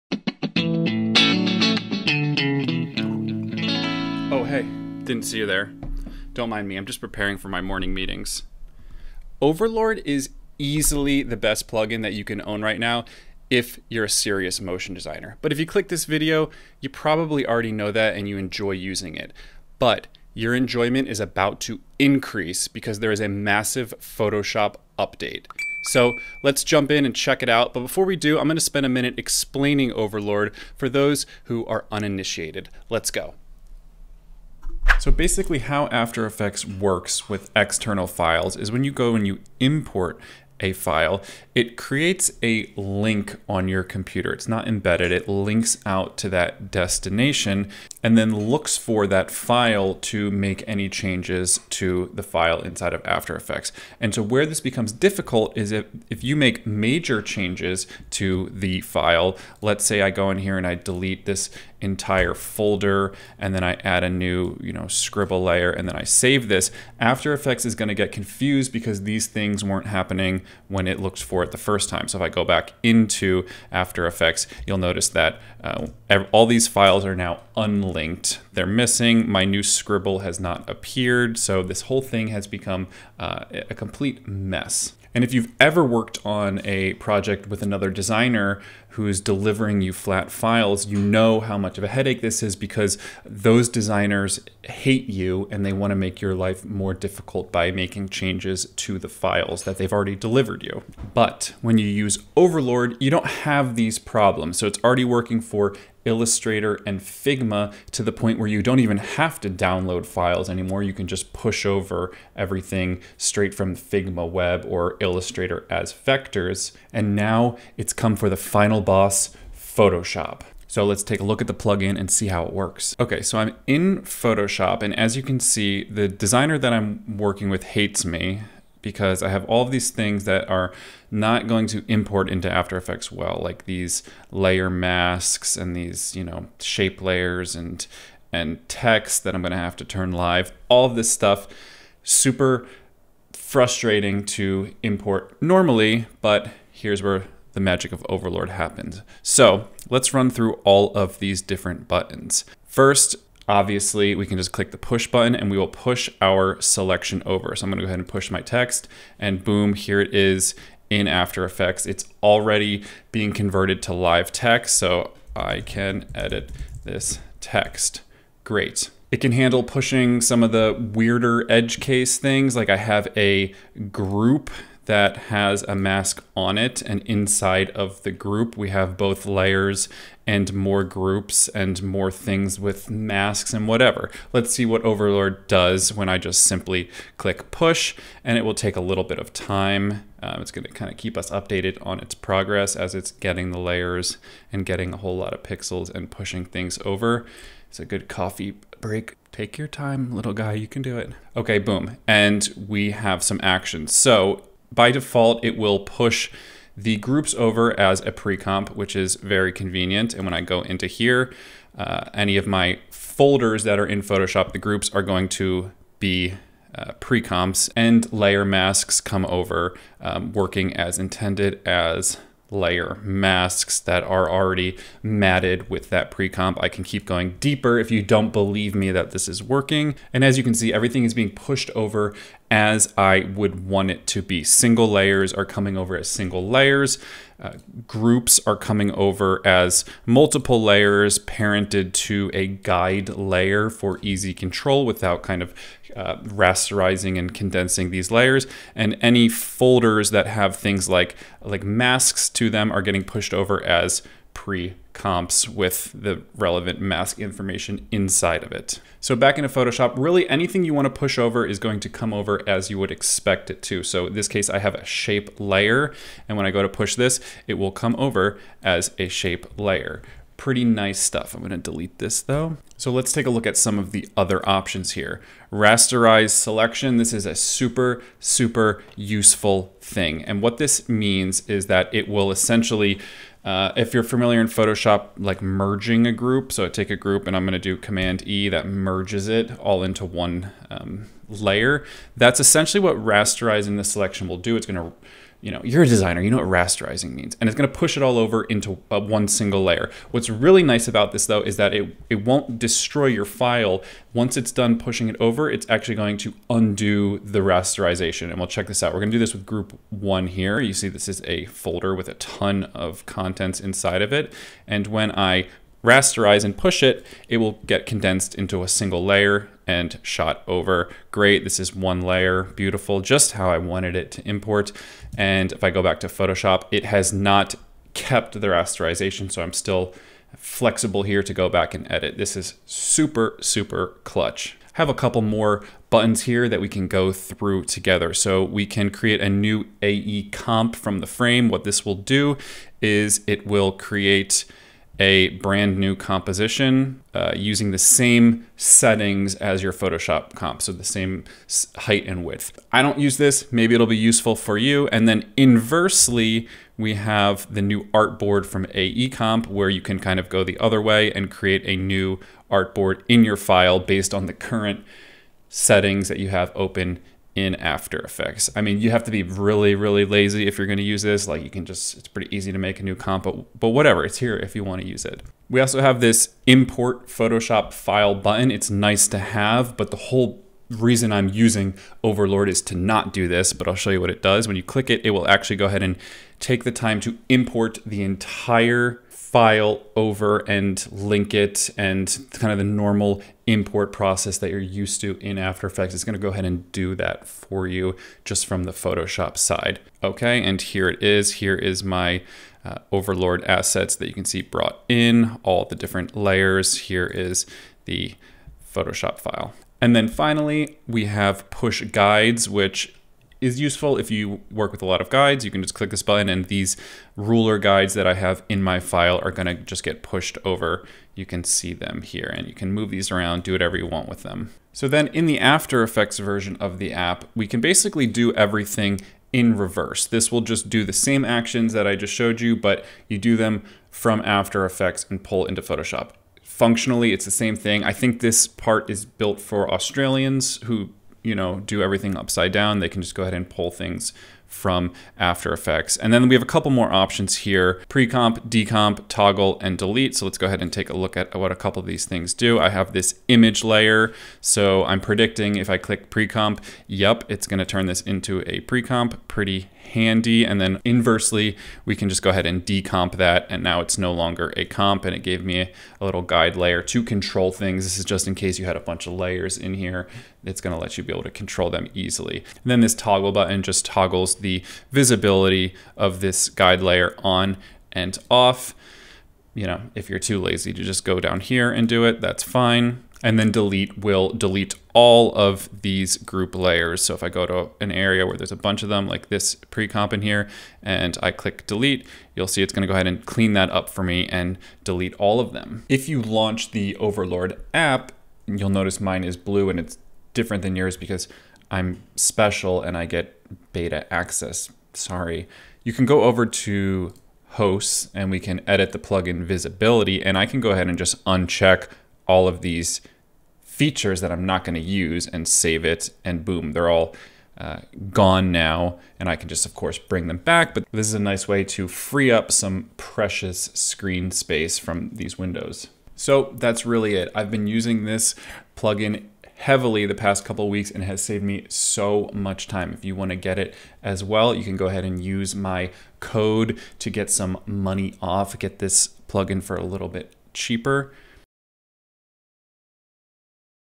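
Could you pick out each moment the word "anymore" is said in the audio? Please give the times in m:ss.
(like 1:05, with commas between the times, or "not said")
1:50.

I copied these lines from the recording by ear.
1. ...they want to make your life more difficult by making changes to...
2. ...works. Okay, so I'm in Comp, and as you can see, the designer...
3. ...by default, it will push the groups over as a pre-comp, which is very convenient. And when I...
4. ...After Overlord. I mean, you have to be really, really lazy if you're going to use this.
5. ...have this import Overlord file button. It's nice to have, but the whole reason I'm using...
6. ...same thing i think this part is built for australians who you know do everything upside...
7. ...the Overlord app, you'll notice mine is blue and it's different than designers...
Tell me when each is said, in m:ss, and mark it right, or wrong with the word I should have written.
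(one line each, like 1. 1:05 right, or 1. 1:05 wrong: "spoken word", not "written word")
1. 1:35 right
2. 2:02 wrong: "Photoshop", not "Comp"
3. 3:24 right
4. 6:07 wrong: "Effects", not "Overlord"
5. 6:15 wrong: "Photoshop", not "Overlord"
6. 7:17 right
7. 8:16 wrong: "yours", not "designers".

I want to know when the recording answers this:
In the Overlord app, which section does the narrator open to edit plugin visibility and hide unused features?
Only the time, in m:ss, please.
8:27.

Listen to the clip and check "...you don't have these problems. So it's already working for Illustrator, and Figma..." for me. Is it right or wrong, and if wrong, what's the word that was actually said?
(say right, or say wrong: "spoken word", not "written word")
right.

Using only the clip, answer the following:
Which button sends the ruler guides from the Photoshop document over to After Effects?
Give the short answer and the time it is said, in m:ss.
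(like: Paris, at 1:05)
push guides, at 6:51.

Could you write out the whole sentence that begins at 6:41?
Here is my uh, Overlord assets that you can see brought in, all the different layers.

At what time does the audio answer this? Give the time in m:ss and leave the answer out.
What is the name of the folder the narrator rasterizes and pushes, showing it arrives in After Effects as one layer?
5:09.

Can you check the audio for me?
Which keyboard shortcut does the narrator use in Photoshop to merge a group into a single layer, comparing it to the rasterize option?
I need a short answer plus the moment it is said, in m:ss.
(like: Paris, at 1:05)
Command E, at 4:47.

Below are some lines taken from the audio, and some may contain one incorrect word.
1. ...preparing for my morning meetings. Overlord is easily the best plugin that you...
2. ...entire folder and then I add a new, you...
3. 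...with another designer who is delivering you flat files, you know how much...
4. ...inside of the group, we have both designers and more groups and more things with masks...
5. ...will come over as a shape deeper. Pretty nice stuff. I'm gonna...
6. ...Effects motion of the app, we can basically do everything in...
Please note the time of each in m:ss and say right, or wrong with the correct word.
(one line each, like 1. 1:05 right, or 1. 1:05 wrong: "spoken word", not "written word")
1. 0:07 right
2. 1:01 right
3. 1:27 right
4. 2:57 wrong: "layers", not "designers"
5. 4:27 wrong: "layer", not "deeper"
6. 7:05 wrong: "version", not "motion".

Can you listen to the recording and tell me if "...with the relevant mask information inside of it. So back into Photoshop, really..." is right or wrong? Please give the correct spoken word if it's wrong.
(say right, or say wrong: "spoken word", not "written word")
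right.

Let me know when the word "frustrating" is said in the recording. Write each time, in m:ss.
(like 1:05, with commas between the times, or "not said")
2:23.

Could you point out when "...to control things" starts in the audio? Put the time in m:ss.
7:46.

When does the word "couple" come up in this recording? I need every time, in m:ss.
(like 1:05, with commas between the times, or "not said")
5:34, 7:26, 7:31, 8:50.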